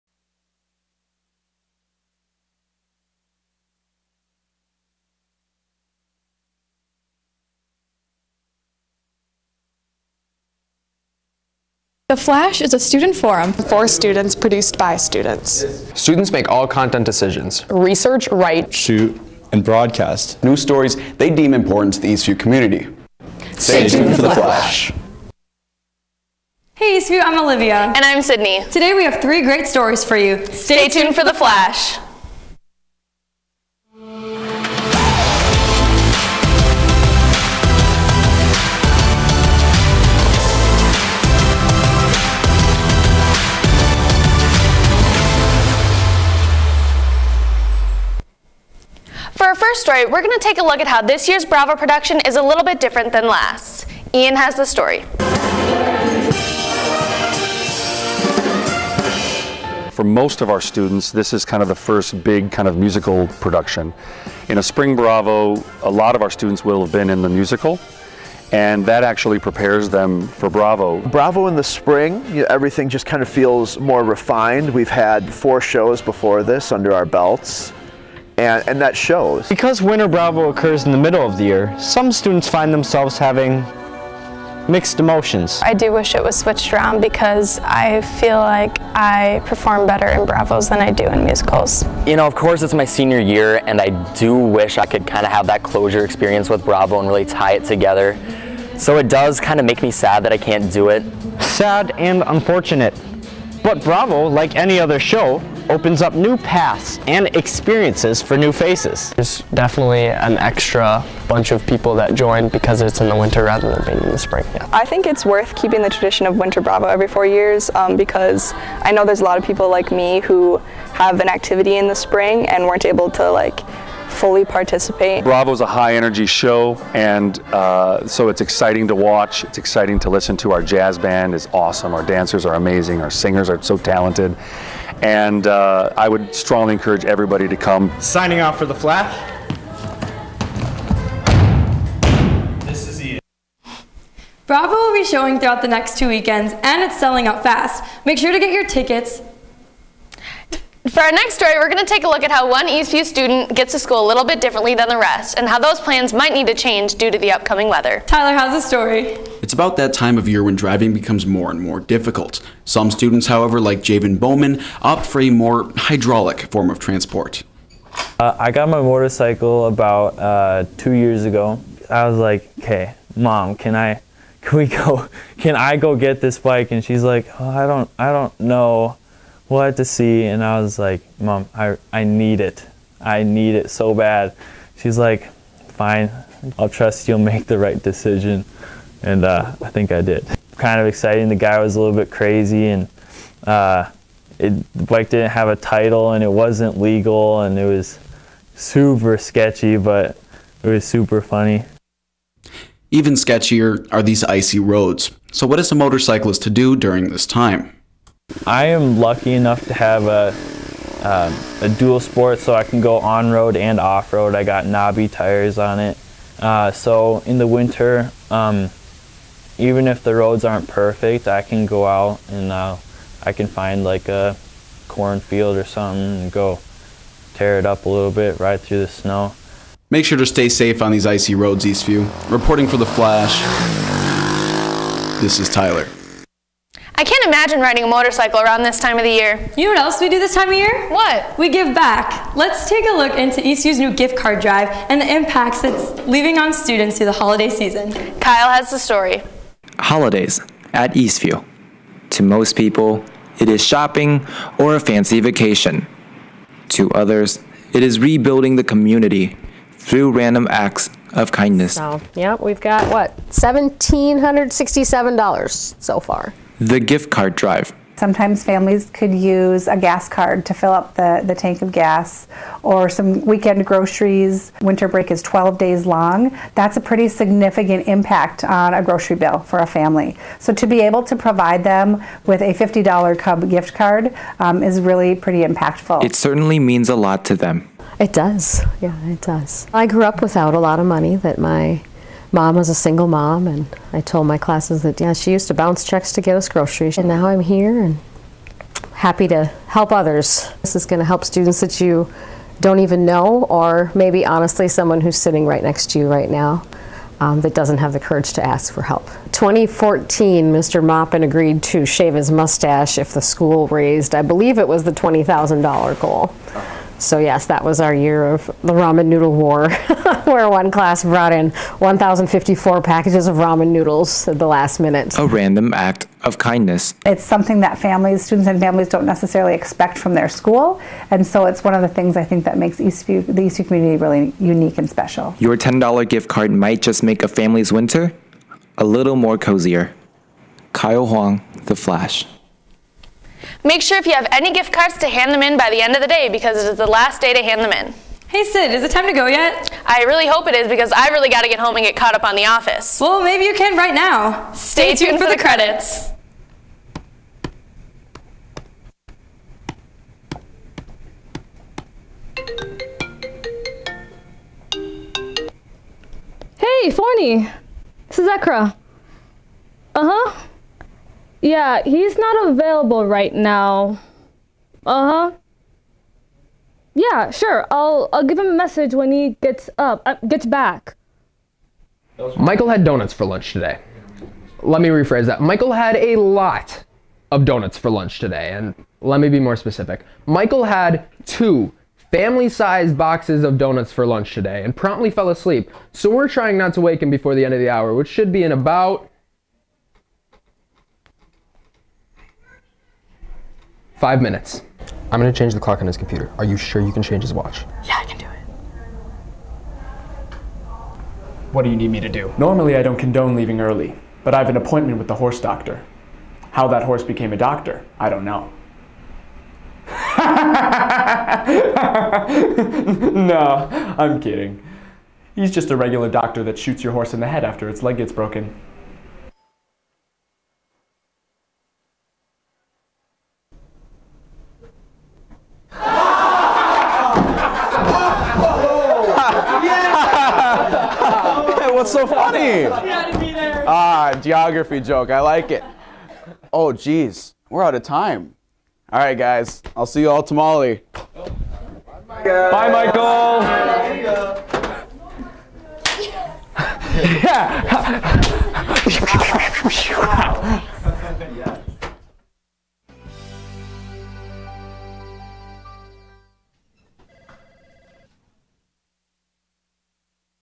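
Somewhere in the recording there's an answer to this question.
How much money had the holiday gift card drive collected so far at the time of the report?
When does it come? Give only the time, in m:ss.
4:23.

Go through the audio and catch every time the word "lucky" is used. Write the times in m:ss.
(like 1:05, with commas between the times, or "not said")
3:28.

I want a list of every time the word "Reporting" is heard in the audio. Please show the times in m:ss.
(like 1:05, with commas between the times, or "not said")
3:52.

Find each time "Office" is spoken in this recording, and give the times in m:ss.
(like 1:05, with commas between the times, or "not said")
5:52.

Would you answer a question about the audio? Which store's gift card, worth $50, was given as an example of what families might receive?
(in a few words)
Cub.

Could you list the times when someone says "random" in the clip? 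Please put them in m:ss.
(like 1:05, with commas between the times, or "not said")
4:20, 5:25.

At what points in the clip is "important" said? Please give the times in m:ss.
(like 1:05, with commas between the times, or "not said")
0:21.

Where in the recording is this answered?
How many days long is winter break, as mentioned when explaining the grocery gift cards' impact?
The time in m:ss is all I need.
4:35.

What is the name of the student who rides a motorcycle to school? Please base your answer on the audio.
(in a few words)
Javen Bowman.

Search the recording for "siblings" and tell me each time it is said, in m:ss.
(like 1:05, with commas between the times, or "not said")
not said.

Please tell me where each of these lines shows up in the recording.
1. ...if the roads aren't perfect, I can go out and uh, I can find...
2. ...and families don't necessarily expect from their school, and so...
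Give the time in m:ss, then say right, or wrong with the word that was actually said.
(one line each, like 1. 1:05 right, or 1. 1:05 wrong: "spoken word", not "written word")
1. 3:39 right
2. 5:28 right.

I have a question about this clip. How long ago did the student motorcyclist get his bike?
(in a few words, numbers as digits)
2 years.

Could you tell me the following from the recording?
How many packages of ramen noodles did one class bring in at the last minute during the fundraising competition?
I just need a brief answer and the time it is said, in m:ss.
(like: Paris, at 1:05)
1,054, at 5:21.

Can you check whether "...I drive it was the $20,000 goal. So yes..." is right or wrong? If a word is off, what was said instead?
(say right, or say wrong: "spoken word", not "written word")
wrong: "believe", not "drive".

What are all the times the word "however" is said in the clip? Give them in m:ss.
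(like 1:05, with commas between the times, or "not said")
2:43.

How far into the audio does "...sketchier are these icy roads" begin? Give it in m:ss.
3:23.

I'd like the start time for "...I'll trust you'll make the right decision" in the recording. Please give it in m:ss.
3:06.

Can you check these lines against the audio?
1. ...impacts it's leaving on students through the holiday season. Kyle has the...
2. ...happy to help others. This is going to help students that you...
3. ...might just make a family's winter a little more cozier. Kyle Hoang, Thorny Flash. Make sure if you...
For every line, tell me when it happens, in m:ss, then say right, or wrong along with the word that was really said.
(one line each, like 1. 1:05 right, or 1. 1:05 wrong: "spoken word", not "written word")
1. 4:05 right
2. 4:58 right
3. 5:36 wrong: "The", not "Thorny".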